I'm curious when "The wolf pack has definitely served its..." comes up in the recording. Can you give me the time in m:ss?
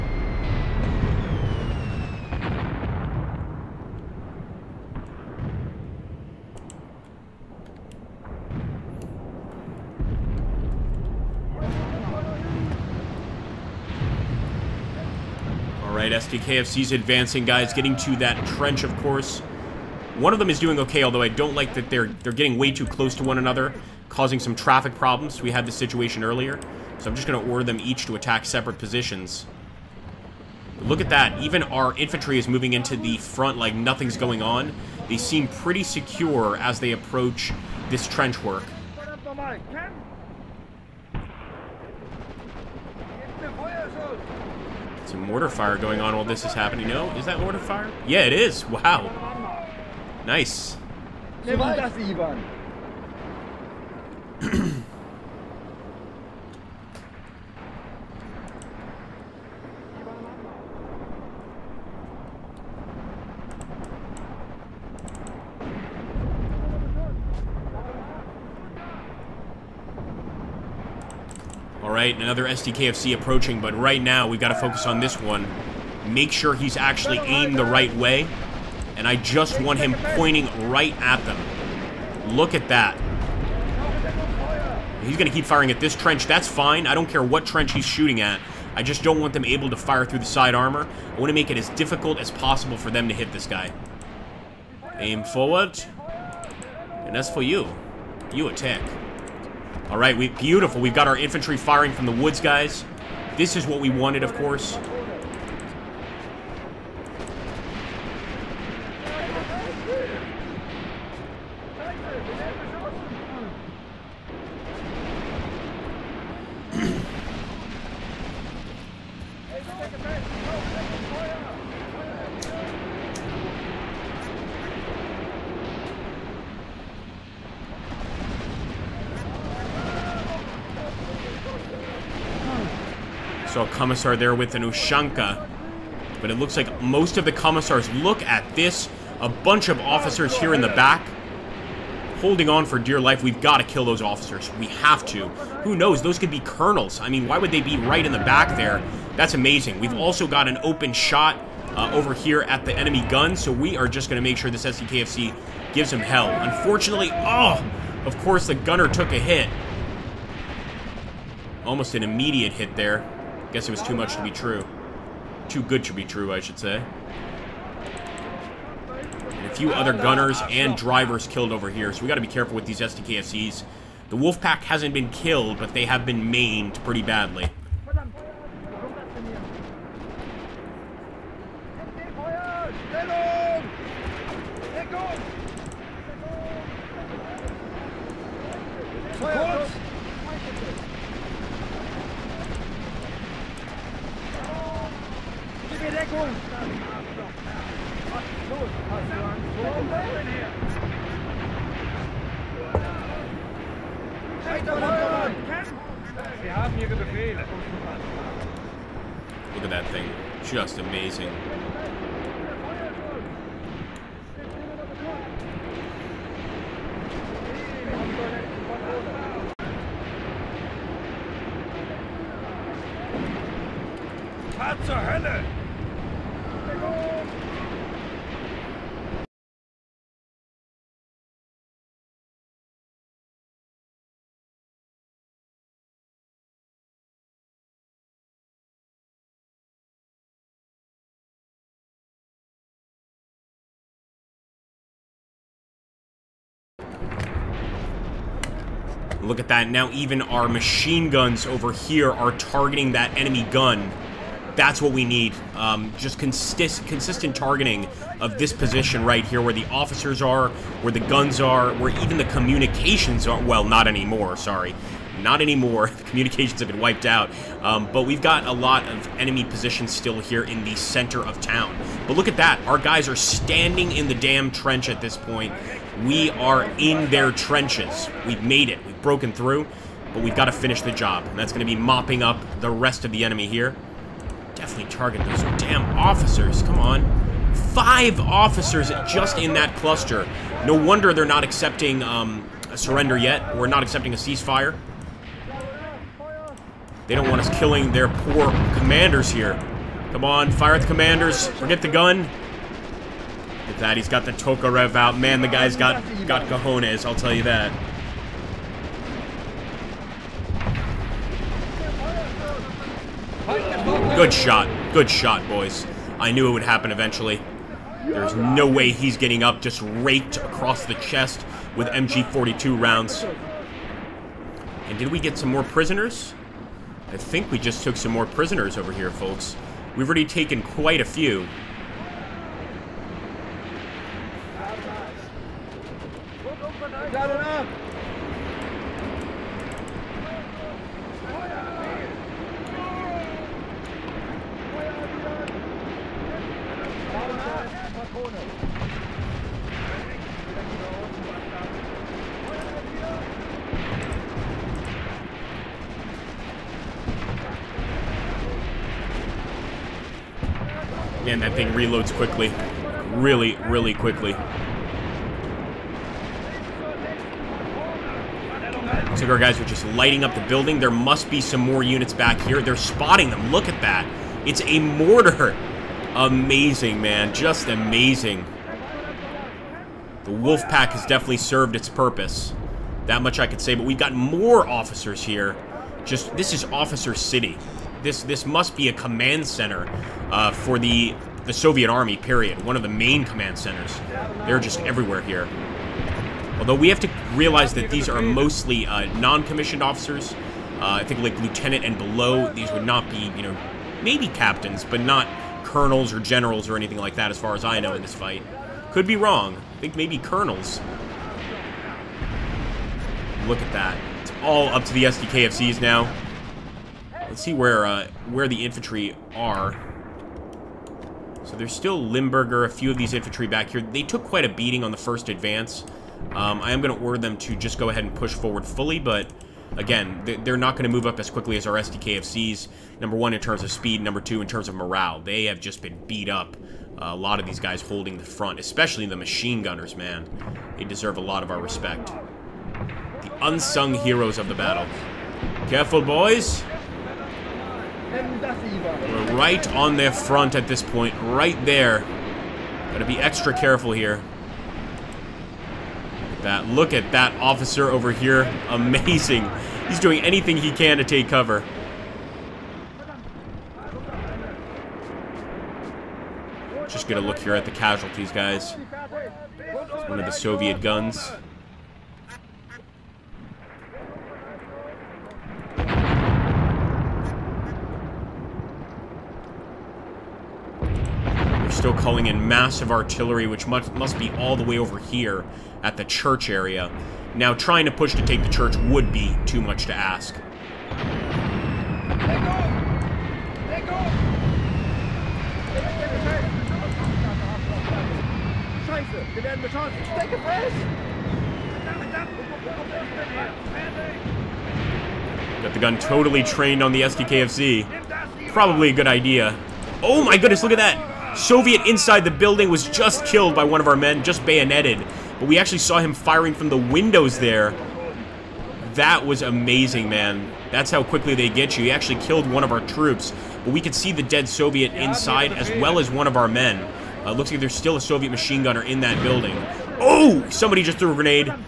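6:20.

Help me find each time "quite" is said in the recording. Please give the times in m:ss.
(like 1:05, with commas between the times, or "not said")
5:30, 7:04.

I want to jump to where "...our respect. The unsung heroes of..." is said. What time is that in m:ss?
7:21.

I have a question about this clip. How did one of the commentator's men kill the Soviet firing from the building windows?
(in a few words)
Bayoneted.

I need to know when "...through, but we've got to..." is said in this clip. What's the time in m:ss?
4:39.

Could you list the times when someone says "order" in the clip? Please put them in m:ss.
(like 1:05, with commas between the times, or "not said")
0:27, 7:07.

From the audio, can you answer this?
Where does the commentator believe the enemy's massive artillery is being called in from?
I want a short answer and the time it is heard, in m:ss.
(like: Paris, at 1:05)
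The church area, at 8:06.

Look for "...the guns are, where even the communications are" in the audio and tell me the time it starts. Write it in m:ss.
4:20.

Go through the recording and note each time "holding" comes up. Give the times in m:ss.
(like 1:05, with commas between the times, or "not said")
2:22, 7:17.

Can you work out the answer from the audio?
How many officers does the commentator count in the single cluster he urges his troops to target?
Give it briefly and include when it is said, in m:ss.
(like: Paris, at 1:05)
5, at 4:47.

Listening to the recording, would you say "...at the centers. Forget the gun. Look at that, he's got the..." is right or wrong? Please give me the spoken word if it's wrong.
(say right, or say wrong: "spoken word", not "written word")
wrong: "commanders", not "centers".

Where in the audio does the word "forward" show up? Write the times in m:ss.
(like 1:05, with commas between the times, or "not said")
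1:35, 7:08.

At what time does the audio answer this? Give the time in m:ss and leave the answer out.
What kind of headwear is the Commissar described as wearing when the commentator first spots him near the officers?
2:14.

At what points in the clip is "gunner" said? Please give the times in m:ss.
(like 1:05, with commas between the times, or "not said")
2:38, 2:49, 7:19, 8:48.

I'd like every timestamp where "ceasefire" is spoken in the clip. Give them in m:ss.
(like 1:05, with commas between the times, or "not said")
4:54.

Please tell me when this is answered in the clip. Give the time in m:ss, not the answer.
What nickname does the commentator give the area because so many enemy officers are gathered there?
6:26.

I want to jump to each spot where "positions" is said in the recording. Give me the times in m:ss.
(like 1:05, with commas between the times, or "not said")
0:28, 4:18, 4:29.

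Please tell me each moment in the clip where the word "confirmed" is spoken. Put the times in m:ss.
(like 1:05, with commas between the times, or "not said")
not said.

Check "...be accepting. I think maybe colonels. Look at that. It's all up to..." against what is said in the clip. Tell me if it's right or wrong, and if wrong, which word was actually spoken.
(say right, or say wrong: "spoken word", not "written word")
wrong: "wrong", not "accepting".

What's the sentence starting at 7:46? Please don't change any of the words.
Just gonna look here at the casualties, guys.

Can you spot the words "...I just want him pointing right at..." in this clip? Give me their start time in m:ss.
1:19.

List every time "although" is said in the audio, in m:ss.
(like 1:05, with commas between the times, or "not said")
0:21, 6:36.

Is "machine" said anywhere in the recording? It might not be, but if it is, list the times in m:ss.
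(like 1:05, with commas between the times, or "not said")
4:10, 7:19, 8:48.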